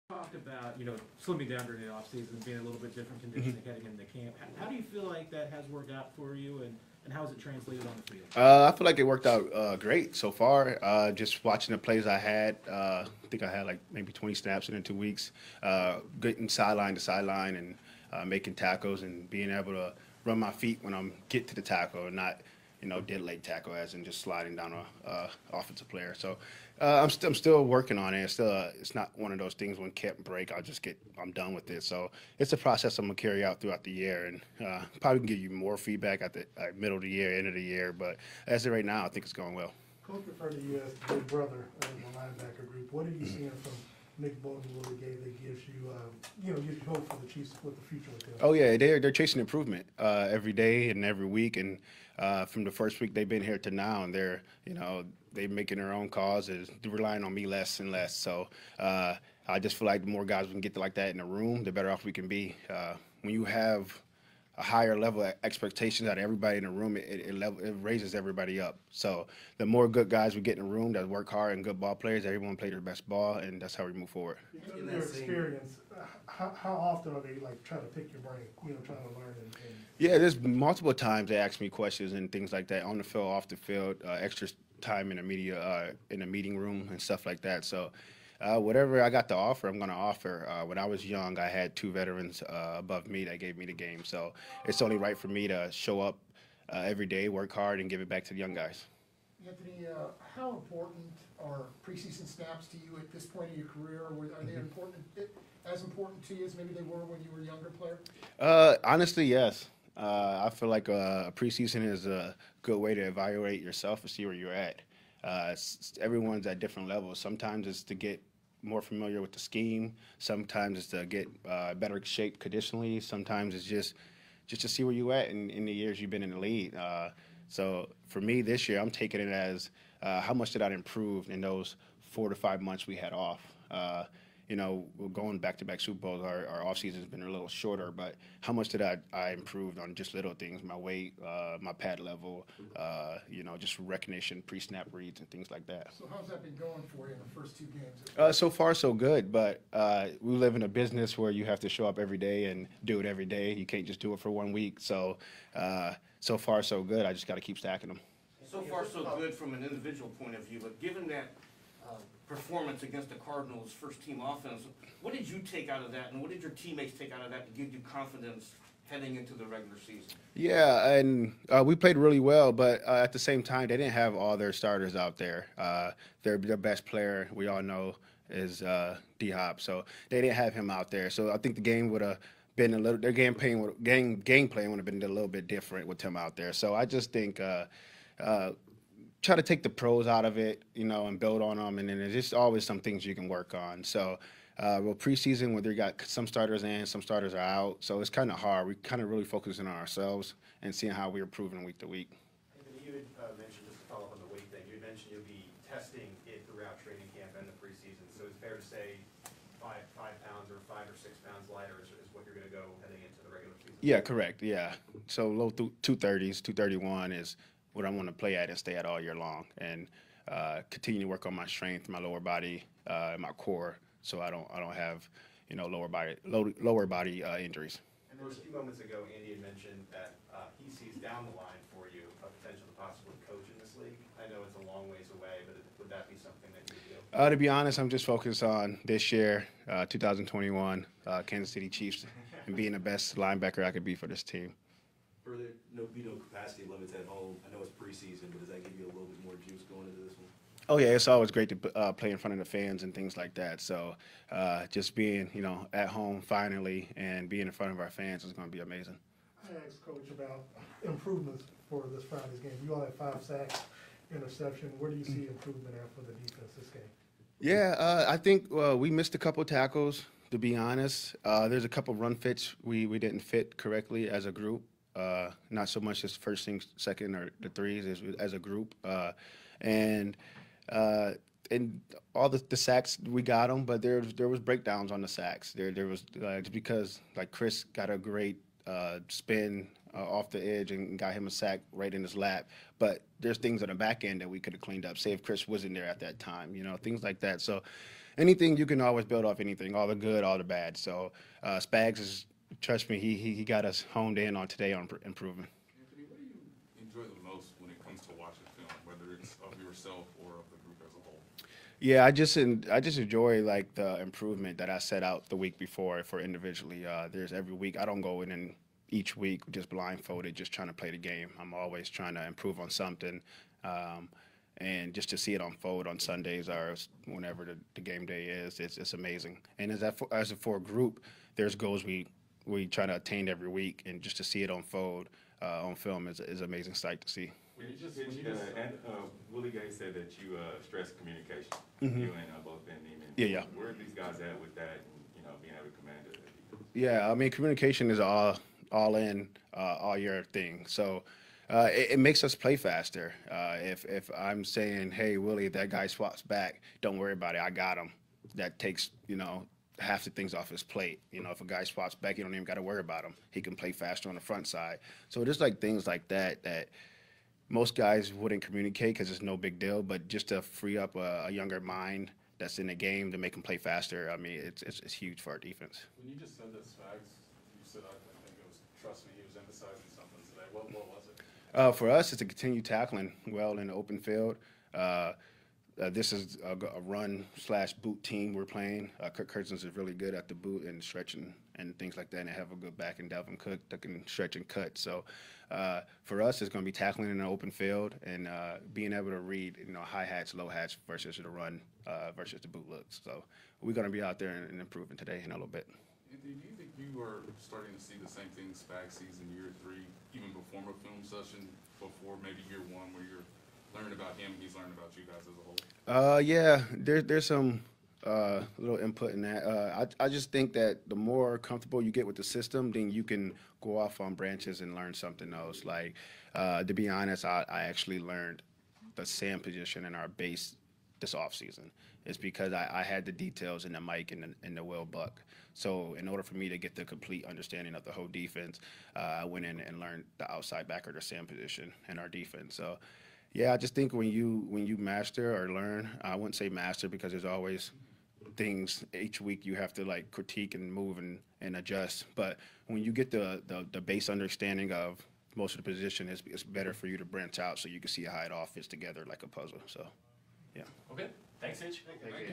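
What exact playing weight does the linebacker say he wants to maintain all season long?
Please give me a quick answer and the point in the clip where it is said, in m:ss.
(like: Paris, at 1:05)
231, at 3:36.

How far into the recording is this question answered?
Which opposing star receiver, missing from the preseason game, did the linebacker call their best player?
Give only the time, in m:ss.
2:59.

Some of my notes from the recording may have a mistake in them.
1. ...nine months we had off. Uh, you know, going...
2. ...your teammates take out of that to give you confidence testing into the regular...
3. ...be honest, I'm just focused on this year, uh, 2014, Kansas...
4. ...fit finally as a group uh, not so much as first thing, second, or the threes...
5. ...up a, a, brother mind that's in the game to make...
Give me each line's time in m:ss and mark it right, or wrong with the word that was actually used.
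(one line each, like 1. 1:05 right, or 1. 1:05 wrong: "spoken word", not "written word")
1. 2:12 wrong: "five", not "nine"
2. 2:46 wrong: "heading", not "testing"
3. 3:57 wrong: "2021", not "2014"
4. 4:33 wrong: "correctly", not "finally"
5. 6:10 wrong: "younger", not "brother".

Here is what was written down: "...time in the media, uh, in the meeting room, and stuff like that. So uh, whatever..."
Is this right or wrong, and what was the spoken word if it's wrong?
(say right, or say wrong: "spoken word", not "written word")
right.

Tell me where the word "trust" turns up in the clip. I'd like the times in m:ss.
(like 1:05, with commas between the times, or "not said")
5:02, 6:18.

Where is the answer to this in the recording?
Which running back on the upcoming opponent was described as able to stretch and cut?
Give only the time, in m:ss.
6:33.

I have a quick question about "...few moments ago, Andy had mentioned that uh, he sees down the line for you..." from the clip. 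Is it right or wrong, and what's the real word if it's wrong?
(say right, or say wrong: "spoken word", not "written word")
right.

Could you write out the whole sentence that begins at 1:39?
Anthony, uh, how important are preseason snaps to you at this point in your career?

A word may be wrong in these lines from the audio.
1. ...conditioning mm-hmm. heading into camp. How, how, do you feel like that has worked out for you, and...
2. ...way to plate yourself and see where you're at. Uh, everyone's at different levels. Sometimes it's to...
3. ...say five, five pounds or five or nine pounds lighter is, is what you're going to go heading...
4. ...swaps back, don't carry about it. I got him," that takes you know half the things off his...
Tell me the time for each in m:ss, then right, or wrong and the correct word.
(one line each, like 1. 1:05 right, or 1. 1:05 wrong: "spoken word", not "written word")
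1. 0:03 right
2. 1:52 wrong: "evaluate", not "plate"
3. 3:28 wrong: "six", not "nine"
4. 5:55 wrong: "worry", not "carry".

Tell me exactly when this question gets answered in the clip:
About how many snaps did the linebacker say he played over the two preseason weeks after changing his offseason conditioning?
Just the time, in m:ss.
0:14.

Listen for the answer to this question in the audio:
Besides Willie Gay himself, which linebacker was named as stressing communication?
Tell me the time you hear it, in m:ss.
5:42.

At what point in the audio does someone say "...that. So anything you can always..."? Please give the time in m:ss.
4:57.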